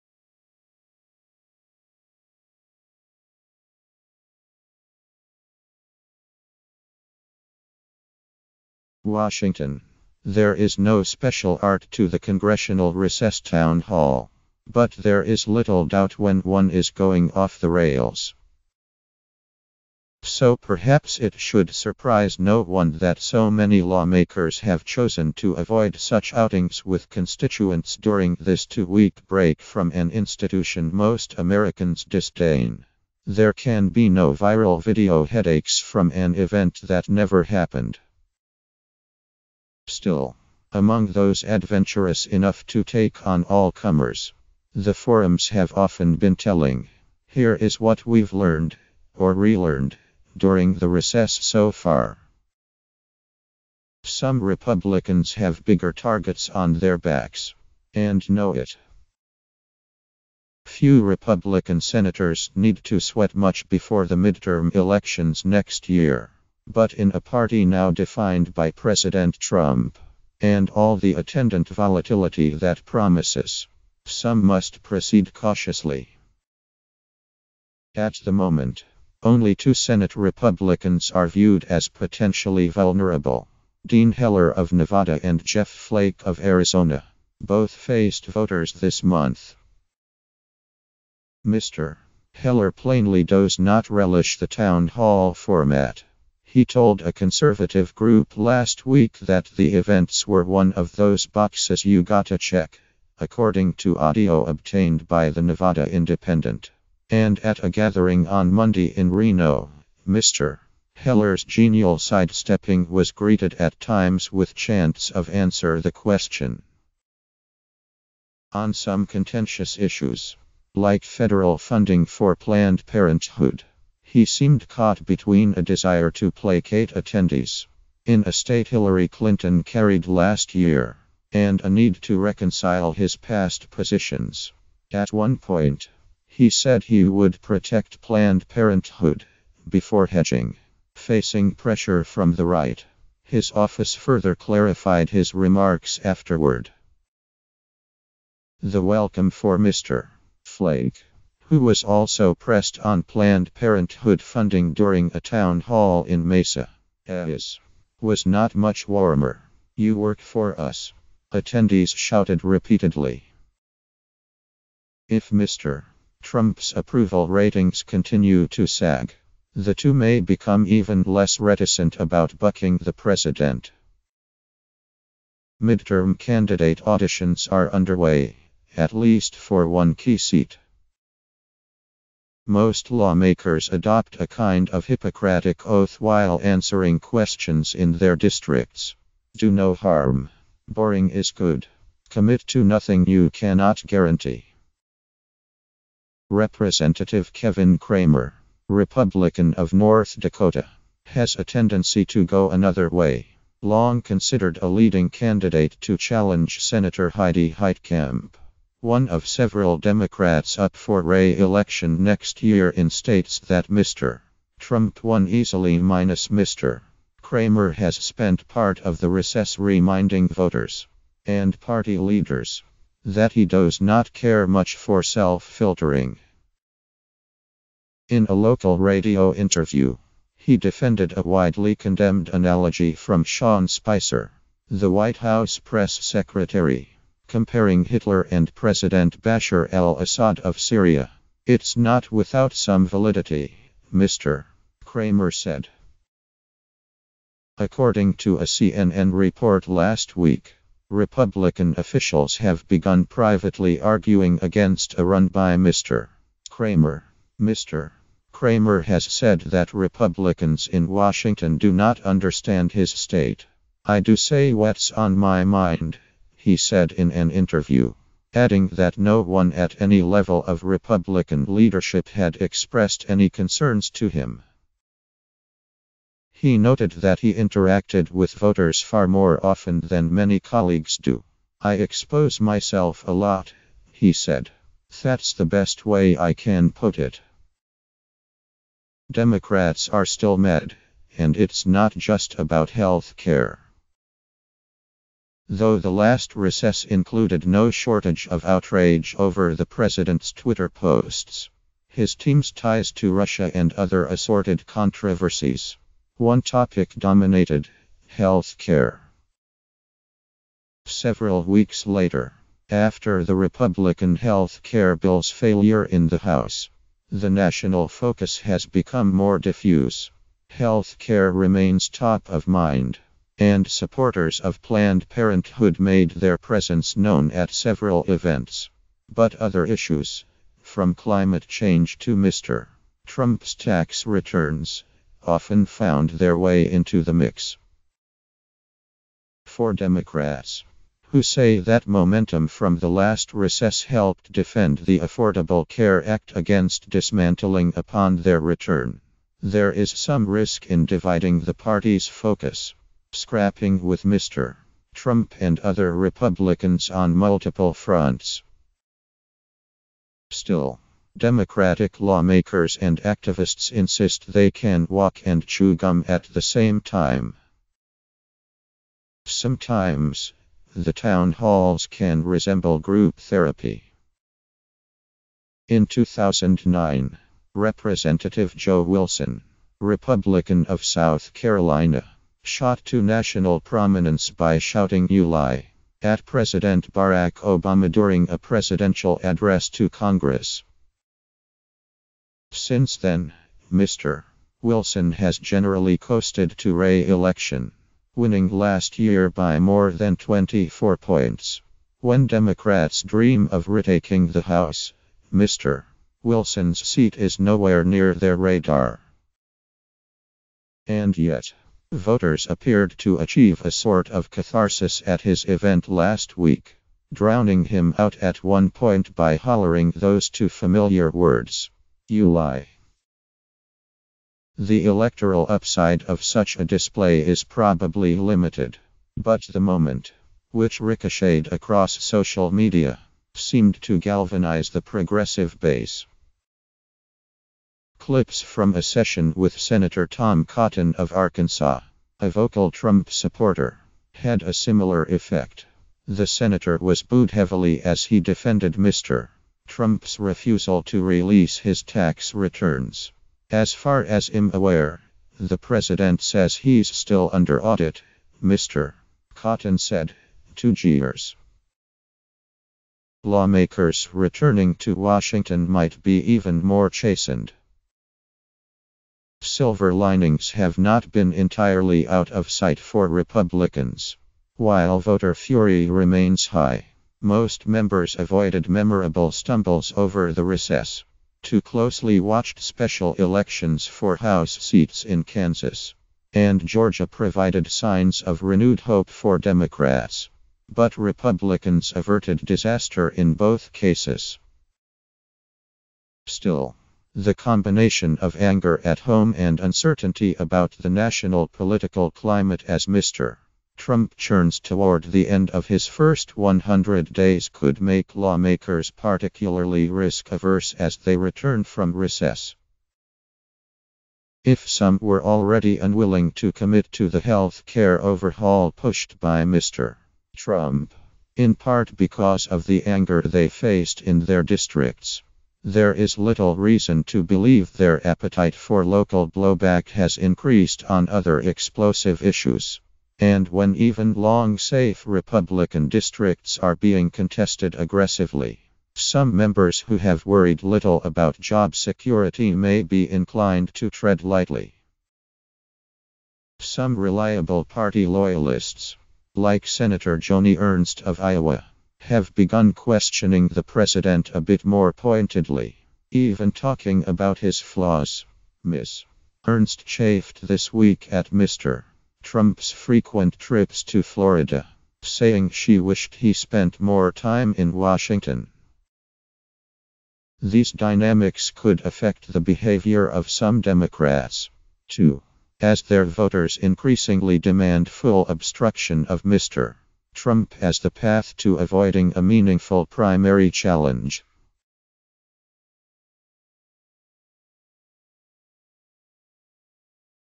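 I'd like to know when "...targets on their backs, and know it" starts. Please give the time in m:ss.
0:55.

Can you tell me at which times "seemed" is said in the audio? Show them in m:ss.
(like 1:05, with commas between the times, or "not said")
2:04, 7:13.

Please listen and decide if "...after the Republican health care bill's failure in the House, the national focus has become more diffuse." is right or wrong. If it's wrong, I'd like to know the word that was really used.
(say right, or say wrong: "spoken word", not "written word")
right.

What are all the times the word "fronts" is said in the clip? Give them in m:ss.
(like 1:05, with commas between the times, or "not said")
5:57.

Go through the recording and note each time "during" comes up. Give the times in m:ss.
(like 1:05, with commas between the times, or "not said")
0:27, 0:50, 2:34, 6:27.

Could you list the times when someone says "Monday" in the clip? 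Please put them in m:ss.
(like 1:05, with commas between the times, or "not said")
1:48.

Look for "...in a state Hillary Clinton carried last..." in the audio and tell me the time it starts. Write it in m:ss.
2:08.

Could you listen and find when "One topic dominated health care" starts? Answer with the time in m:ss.
5:06.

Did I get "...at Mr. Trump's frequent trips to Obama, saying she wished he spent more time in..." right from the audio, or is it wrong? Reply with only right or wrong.
wrong.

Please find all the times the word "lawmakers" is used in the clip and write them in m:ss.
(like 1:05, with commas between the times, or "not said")
0:23, 3:02, 6:01, 7:43, 8:28.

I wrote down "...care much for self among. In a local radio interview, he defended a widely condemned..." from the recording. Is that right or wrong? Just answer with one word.
wrong.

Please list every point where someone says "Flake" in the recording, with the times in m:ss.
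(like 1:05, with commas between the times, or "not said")
1:25, 2:30.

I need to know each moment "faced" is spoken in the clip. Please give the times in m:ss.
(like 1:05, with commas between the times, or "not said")
1:27, 8:43.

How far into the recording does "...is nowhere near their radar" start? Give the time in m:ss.
6:47.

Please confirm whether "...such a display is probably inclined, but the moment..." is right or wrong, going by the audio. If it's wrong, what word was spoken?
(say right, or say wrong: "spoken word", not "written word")
wrong: "limited", not "inclined".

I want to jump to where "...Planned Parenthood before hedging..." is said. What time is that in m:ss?
2:18.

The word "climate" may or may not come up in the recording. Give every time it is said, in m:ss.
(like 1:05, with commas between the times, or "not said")
5:30, 8:22.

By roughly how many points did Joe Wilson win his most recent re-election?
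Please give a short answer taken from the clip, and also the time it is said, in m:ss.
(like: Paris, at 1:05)
24, at 6:40.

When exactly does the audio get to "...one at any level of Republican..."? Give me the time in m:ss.
4:29.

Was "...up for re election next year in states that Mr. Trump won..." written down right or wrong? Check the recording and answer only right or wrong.
right.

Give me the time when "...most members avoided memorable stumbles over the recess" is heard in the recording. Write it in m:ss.
7:57.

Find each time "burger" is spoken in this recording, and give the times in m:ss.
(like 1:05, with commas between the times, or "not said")
not said.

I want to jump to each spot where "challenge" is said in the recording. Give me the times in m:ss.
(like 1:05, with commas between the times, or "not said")
3:25, 9:43.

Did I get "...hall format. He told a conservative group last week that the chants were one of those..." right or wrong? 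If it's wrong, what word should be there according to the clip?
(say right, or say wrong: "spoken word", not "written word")
wrong: "events", not "chants".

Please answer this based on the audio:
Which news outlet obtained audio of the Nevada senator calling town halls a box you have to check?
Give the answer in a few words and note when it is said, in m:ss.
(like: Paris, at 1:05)
Nevada Independent, at 1:45.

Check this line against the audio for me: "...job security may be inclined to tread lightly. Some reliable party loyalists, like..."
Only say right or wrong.
right.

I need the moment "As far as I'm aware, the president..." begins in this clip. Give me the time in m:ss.
7:33.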